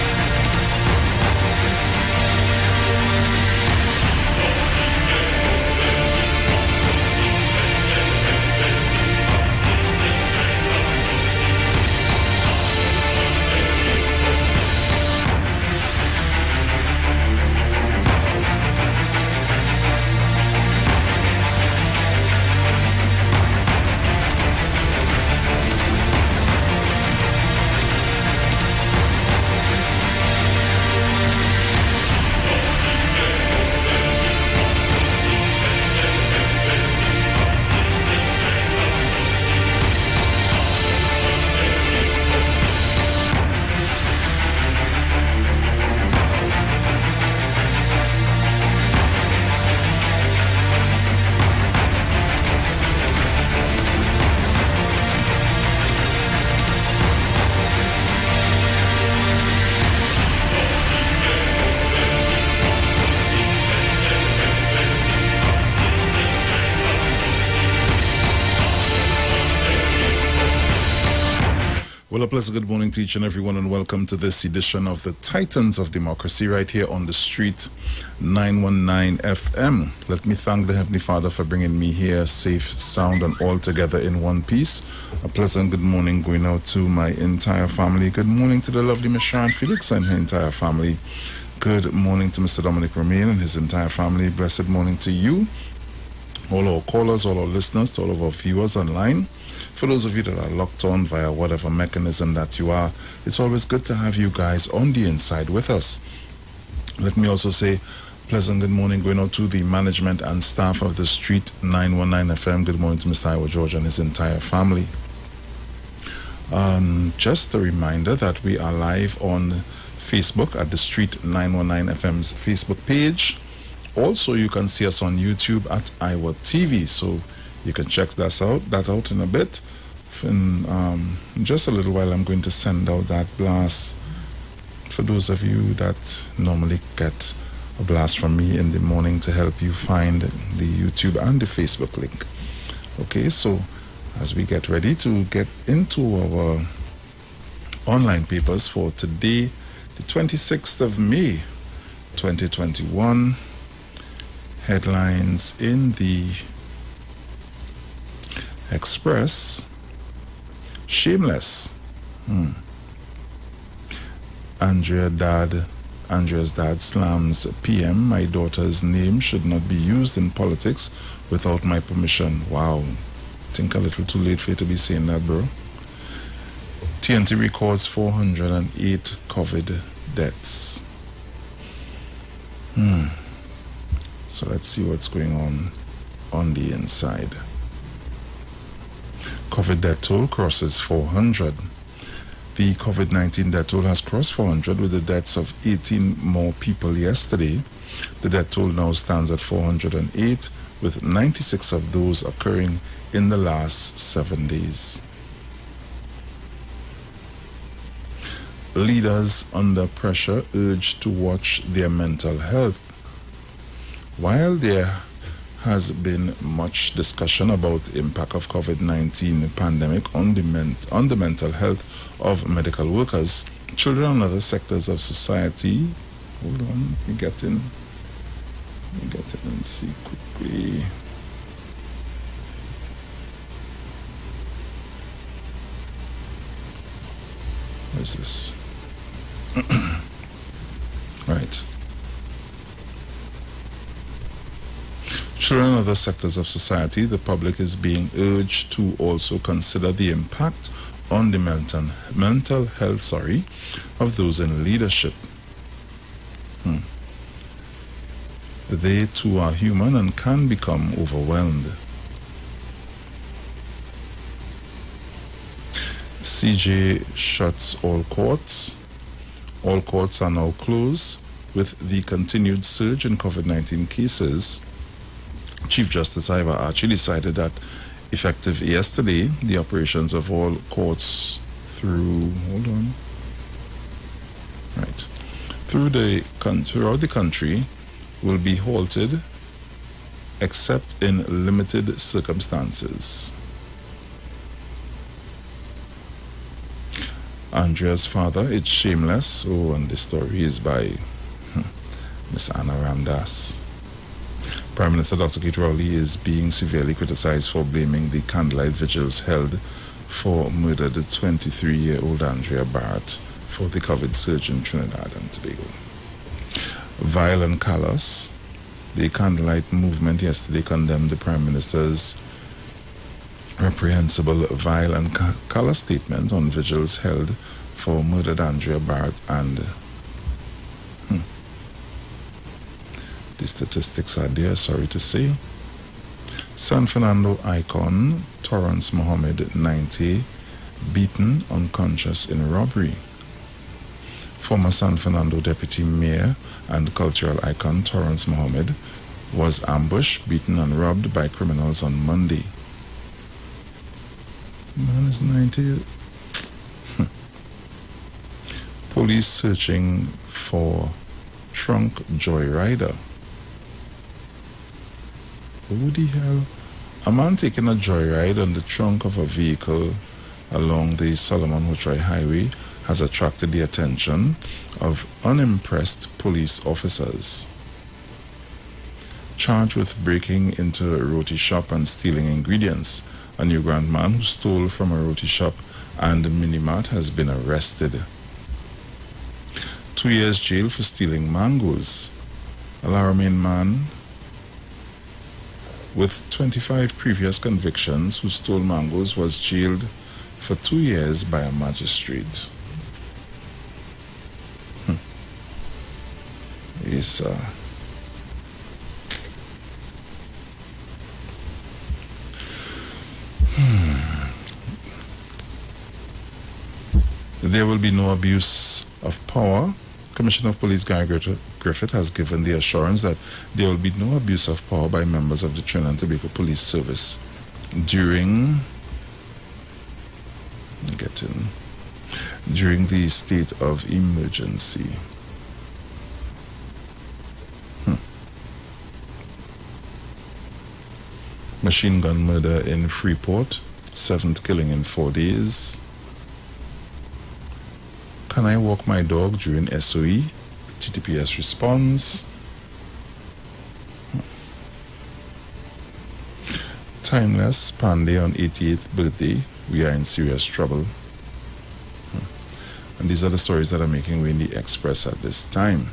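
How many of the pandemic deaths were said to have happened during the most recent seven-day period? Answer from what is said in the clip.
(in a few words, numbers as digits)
96.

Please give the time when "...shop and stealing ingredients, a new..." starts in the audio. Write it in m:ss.
6:21.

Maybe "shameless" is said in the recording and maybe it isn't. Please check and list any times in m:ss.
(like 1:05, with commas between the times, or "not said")
2:40, 4:58.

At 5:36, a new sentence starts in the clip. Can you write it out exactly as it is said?
San Fernando icon Torrance Mohammed 90 beaten unconscious in robbery.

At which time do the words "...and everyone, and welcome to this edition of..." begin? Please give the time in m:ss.
1:13.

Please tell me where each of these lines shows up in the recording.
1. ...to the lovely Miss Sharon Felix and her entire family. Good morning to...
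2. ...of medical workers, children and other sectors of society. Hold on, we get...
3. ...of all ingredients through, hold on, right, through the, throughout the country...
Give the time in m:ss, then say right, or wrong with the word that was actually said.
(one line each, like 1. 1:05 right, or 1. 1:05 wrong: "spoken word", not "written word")
1. 1:28 right
2. 3:42 right
3. 4:40 wrong: "courts", not "ingredients".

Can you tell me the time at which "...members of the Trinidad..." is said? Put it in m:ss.
7:05.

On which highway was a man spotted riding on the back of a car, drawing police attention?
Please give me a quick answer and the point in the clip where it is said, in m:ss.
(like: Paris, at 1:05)
Solomon Hochoy Highway, at 6:11.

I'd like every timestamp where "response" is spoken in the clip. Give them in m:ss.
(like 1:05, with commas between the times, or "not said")
7:31.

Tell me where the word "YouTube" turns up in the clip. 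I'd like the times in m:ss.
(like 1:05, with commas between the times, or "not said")
2:05, 2:20.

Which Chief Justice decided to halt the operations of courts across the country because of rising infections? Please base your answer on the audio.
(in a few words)
Ivor Archie.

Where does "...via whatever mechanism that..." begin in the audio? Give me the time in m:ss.
1:41.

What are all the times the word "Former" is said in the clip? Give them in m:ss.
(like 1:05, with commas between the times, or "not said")
5:44.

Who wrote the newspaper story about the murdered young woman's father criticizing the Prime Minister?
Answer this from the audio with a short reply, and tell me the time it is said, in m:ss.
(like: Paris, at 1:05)
Anna Ramdass, at 5:02.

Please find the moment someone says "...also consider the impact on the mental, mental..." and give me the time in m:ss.
4:08.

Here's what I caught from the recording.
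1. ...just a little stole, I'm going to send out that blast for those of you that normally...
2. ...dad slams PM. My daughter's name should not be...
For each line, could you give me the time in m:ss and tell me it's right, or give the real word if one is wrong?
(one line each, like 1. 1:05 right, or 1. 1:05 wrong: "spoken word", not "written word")
1. 2:11 wrong: "while", not "stole"
2. 2:46 right.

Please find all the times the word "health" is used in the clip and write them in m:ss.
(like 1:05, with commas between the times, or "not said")
3:32, 3:41, 4:12.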